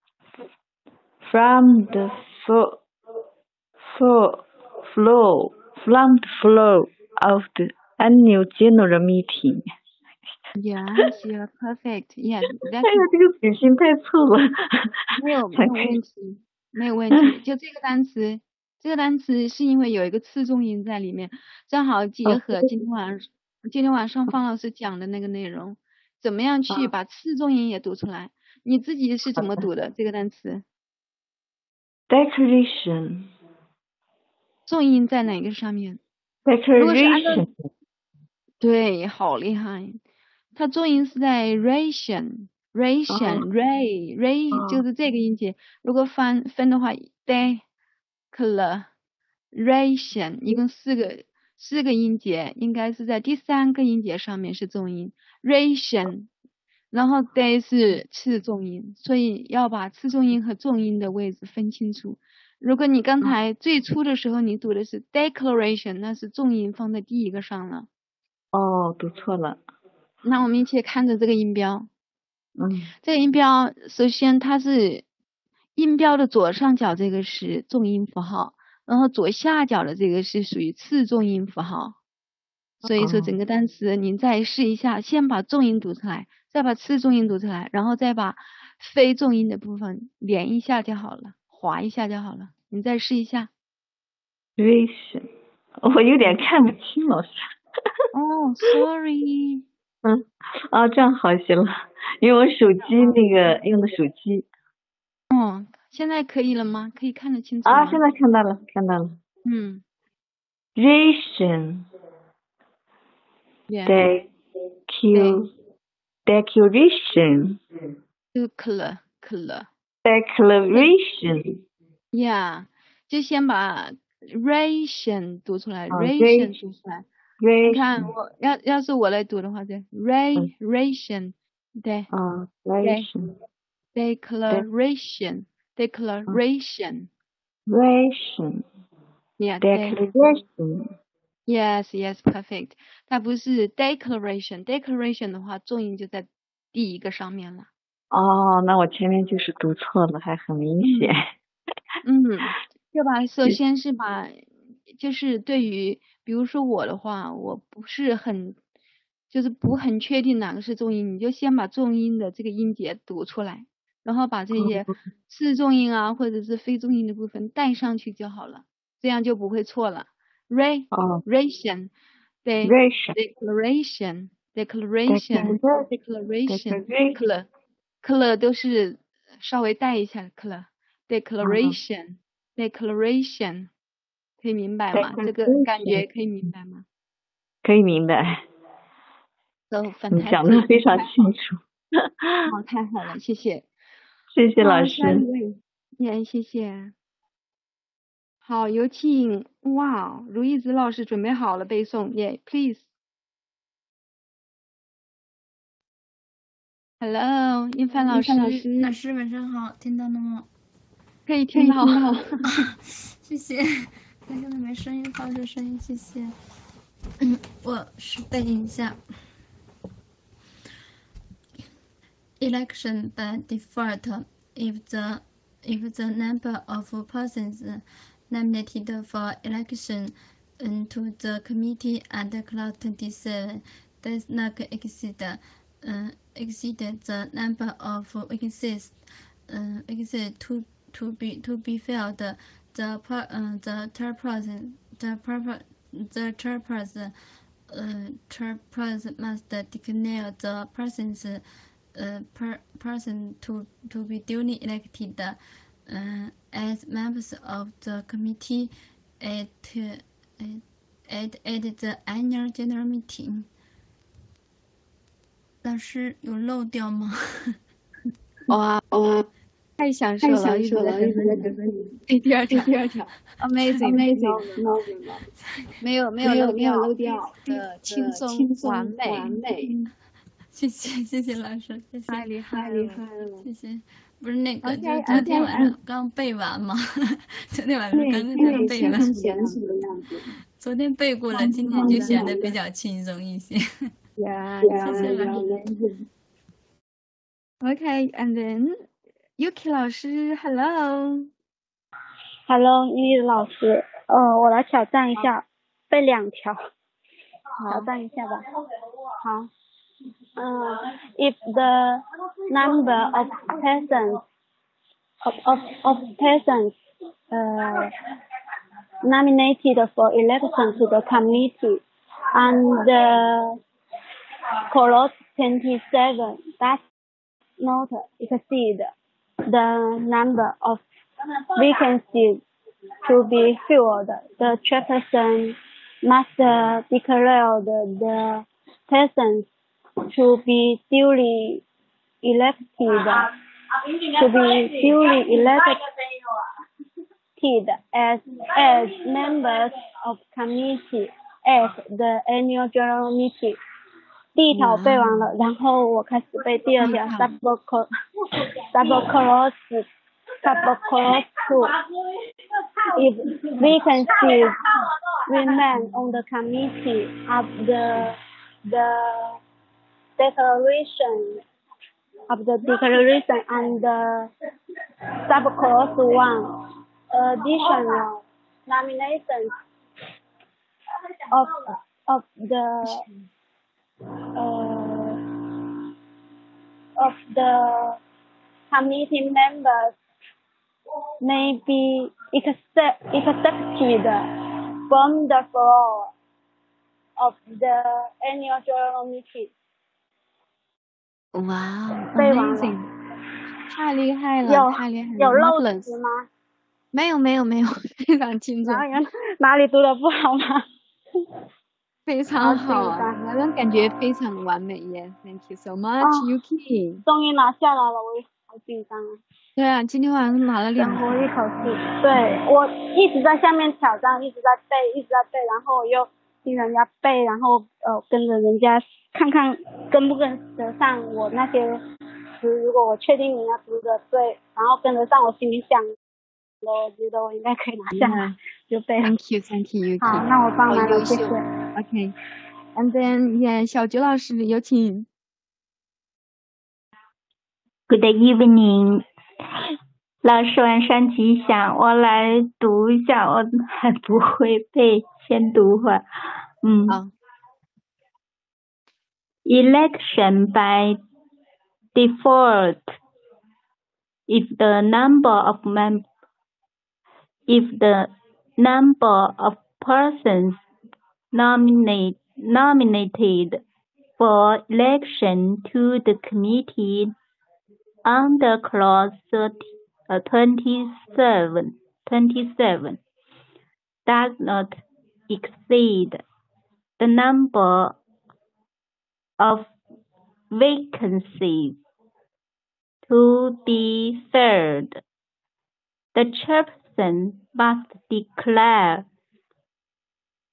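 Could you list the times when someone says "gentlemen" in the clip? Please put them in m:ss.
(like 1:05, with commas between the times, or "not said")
not said.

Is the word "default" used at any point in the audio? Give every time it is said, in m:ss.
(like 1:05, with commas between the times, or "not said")
3:43, 7:41.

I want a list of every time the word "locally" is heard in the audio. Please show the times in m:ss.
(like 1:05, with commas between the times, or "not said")
not said.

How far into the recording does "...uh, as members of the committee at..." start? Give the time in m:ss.
4:15.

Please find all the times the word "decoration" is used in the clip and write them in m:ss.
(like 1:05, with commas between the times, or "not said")
0:32, 0:36, 0:49.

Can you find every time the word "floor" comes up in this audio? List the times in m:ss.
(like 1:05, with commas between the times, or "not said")
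6:35.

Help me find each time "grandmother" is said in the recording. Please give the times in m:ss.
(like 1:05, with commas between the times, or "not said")
not said.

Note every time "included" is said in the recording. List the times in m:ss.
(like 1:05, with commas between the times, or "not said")
not said.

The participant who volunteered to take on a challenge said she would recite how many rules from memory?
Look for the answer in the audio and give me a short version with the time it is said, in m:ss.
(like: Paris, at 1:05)
2, at 5:05.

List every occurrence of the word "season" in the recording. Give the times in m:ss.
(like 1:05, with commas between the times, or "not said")
not said.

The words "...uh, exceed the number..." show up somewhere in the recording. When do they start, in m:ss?
3:55.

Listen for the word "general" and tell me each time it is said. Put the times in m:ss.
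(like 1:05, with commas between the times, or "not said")
0:08, 4:22, 5:52, 6:38.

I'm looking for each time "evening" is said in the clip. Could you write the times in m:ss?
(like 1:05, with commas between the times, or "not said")
7:28.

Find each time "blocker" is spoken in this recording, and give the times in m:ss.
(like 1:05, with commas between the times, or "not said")
not said.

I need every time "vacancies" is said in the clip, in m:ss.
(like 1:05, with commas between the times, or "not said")
3:58, 5:31, 6:03, 8:10.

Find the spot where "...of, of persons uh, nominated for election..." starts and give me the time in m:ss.
5:15.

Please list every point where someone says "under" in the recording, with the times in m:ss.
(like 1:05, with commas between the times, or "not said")
3:52, 7:58.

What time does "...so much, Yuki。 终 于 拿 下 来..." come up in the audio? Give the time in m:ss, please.
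6:55.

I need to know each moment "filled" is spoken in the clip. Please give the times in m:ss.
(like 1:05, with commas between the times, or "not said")
4:01, 5:33, 8:14.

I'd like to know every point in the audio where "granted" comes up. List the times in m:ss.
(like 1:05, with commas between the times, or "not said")
not said.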